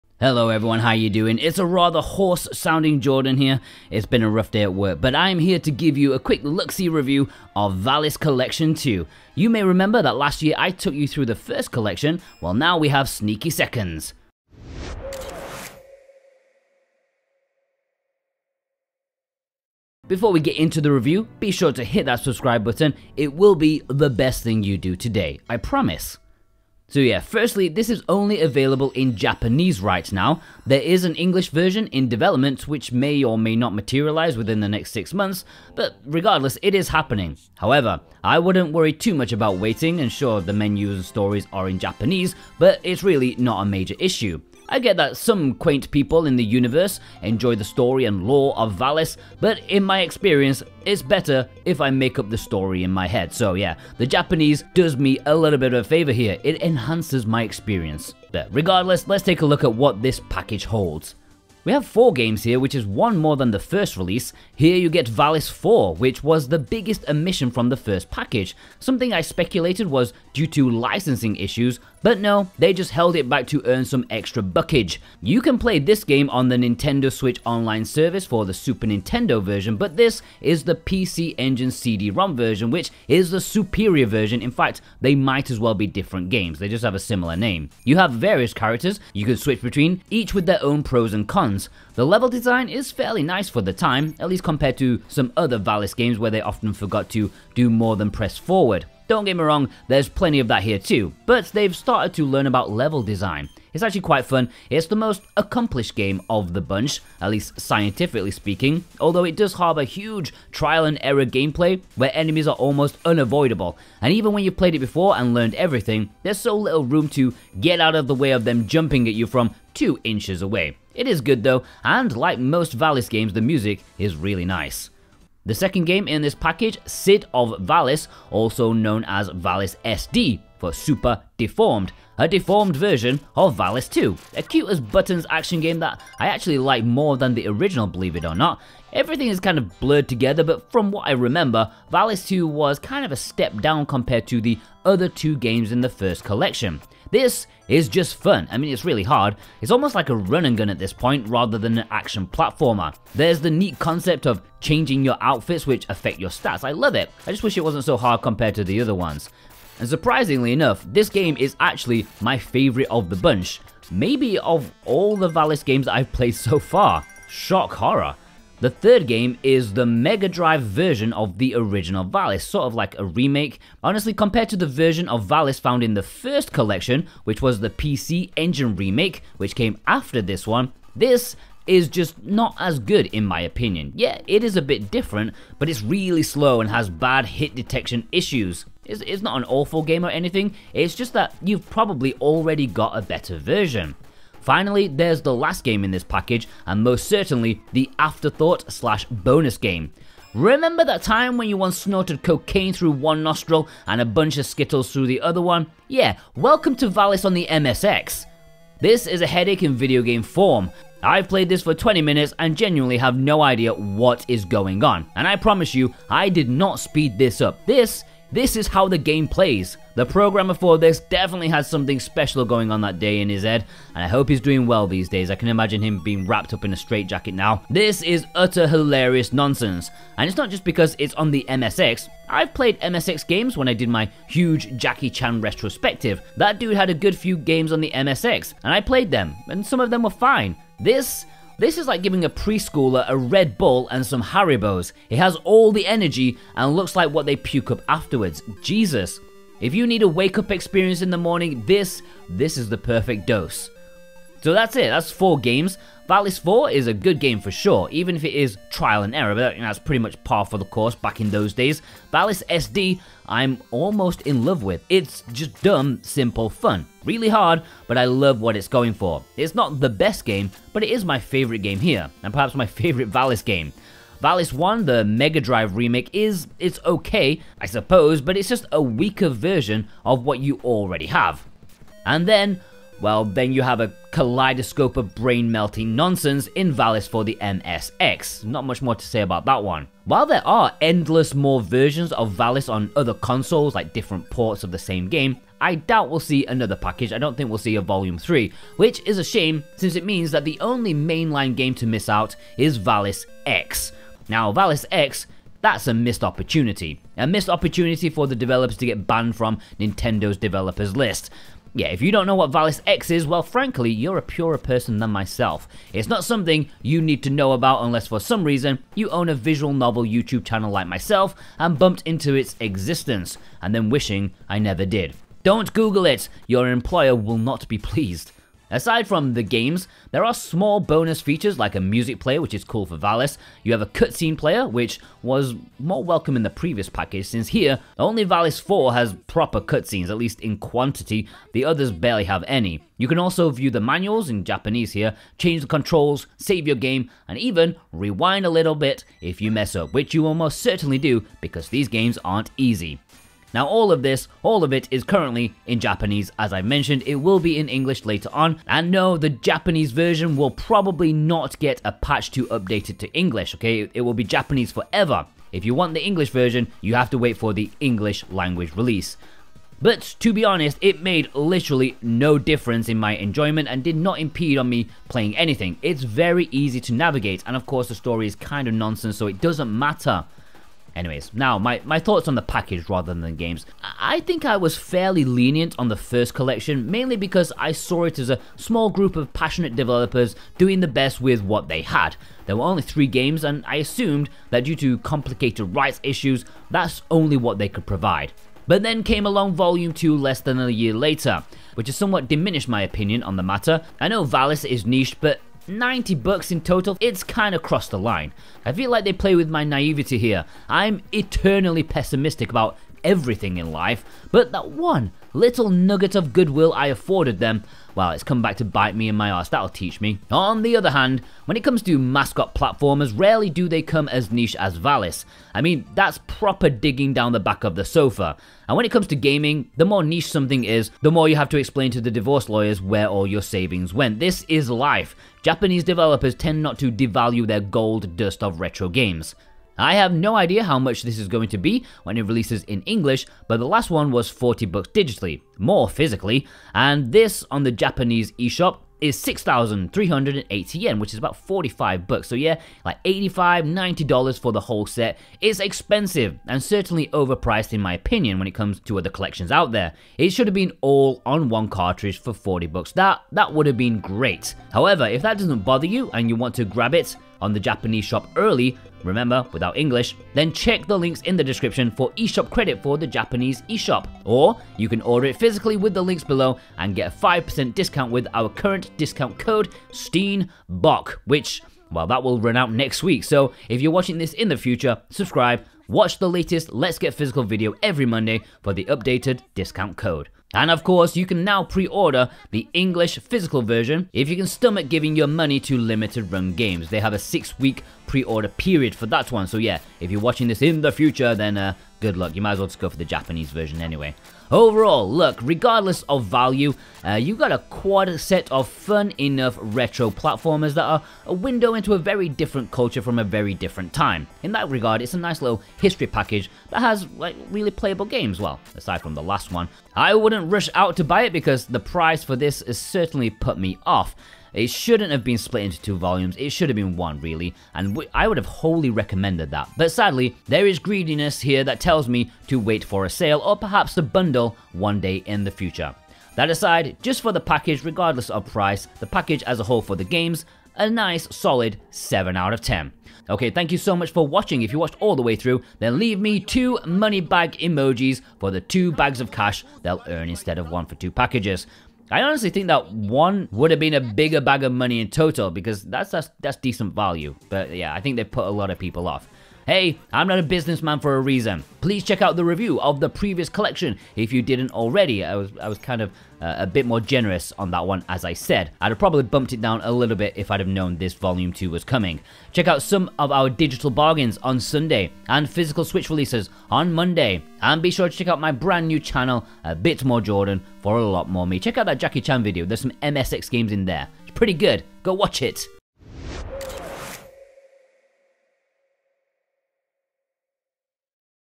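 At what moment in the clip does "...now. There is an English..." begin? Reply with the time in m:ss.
0:30.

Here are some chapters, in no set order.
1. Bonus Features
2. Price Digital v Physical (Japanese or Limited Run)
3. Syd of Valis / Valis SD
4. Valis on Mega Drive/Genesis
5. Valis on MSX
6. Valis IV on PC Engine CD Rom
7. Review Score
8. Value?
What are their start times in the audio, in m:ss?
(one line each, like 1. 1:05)
1. 5:28
2. 7:19
3. 2:05
4. 2:49
5. 3:20
6. 1:01
7. 8:24
8. 6:23.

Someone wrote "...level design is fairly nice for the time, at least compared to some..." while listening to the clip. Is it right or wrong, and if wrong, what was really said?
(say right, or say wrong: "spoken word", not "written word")
right.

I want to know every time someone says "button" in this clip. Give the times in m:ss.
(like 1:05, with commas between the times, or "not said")
0:22, 2:14.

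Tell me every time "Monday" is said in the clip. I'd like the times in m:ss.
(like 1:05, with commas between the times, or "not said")
8:08, 9:36.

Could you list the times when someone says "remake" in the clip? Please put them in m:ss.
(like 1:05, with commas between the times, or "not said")
2:53, 2:58, 4:35.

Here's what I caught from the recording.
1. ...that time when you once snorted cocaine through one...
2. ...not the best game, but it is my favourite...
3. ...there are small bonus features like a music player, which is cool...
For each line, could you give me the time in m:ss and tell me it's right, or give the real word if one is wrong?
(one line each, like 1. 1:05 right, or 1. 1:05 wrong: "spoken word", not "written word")
1. 3:20 right
2. 4:29 right
3. 5:30 right.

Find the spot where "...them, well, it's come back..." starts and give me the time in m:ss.
6:57.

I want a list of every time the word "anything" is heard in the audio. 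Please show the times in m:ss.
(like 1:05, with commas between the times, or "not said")
3:10, 6:15.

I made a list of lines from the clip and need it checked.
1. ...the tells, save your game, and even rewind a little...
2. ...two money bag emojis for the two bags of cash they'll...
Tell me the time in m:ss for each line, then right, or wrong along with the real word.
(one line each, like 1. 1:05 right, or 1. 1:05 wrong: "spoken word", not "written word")
1. 5:45 wrong: "controls", not "tells"
2. 9:06 right.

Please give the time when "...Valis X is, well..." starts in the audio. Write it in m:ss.
5:12.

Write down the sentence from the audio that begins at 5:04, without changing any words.
Now, Valis X that's a missed opportunity.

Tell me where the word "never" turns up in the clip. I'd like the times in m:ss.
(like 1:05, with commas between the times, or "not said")
5:24.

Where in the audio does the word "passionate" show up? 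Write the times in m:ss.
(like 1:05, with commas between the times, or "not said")
6:29.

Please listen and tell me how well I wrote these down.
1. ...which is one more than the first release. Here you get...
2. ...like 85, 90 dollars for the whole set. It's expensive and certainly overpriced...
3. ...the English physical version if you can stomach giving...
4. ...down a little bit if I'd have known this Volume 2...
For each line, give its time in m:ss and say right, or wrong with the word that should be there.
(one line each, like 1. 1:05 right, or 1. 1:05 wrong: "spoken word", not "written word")
1. 1:02 right
2. 7:32 right
3. 8:12 right
4. 9:29 right.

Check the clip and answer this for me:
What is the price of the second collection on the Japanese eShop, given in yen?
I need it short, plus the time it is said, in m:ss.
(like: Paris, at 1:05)
6,380 yen, at 7:29.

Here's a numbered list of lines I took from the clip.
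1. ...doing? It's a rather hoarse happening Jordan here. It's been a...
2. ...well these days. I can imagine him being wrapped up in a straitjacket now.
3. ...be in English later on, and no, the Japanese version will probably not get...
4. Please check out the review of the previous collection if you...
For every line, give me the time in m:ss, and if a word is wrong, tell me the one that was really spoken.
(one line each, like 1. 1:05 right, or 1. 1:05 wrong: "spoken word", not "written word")
1. 0:01 wrong: "sounding", not "happening"
2. 3:44 right
3. 5:57 right
4. 9:21 right.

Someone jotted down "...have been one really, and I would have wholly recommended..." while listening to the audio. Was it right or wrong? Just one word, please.
right.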